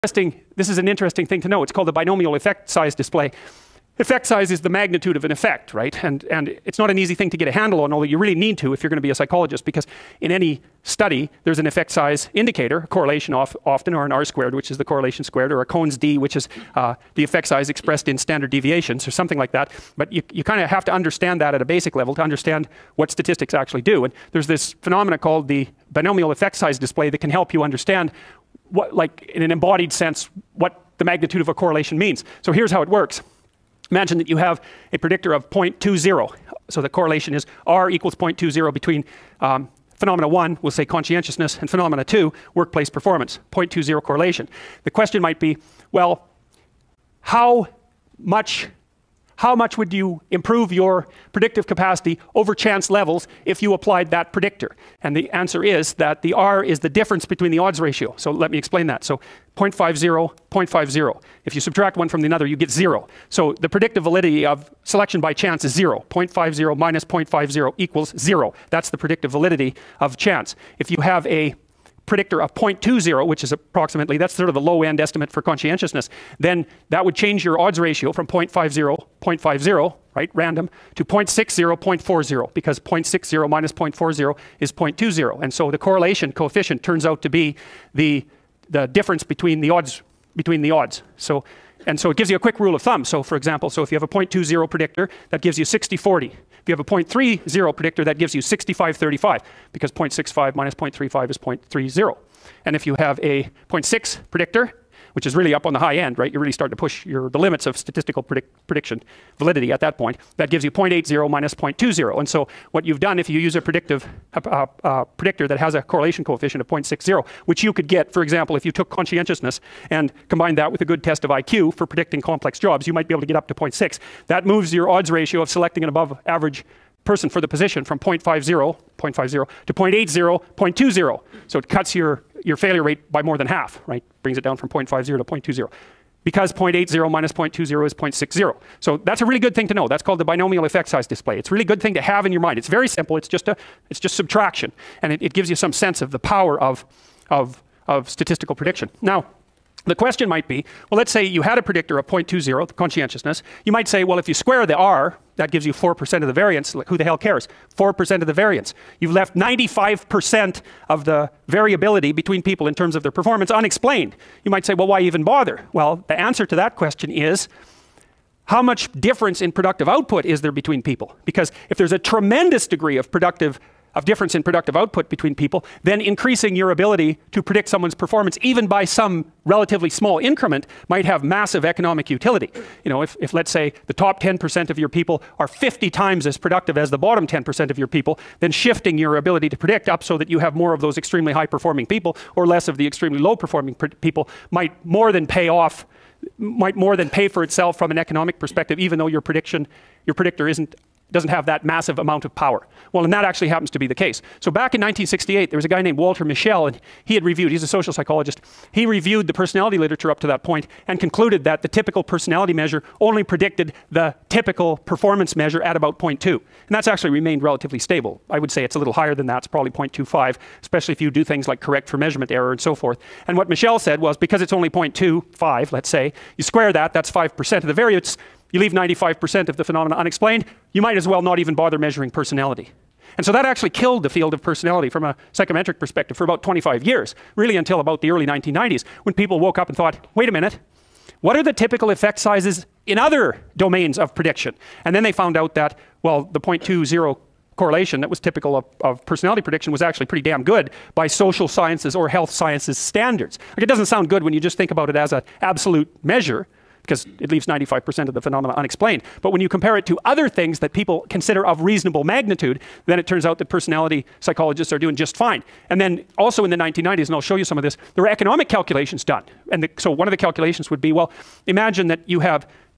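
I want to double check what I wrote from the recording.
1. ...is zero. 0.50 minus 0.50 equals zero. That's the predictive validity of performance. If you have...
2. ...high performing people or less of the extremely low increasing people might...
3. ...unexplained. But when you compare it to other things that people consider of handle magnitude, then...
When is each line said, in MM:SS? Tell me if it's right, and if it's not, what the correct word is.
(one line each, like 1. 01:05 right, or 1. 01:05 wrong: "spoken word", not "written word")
1. 01:05 wrong: "chance", not "performance"
2. 03:11 wrong: "performing", not "increasing"
3. 04:18 wrong: "reasonable", not "handle".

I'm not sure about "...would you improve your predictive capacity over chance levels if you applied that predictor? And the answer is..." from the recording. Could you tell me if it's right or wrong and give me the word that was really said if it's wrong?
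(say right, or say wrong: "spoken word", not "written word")
right.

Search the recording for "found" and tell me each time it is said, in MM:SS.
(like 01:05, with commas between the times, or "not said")
04:05.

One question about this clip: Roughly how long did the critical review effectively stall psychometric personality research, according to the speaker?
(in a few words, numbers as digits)
25 years.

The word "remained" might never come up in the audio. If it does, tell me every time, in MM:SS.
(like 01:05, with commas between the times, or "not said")
03:37.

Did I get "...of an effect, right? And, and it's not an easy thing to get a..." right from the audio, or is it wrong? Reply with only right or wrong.
right.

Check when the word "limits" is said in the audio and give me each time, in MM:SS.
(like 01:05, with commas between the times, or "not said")
01:47.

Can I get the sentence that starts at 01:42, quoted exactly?
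And if you have a 0.6 predictor, which is really up on the high end, right?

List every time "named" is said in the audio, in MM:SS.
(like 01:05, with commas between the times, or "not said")
03:25.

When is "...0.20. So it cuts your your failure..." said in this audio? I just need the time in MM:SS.
02:10.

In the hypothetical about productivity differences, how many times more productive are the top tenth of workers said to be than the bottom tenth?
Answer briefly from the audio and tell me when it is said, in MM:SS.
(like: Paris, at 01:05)
50, at 03:05.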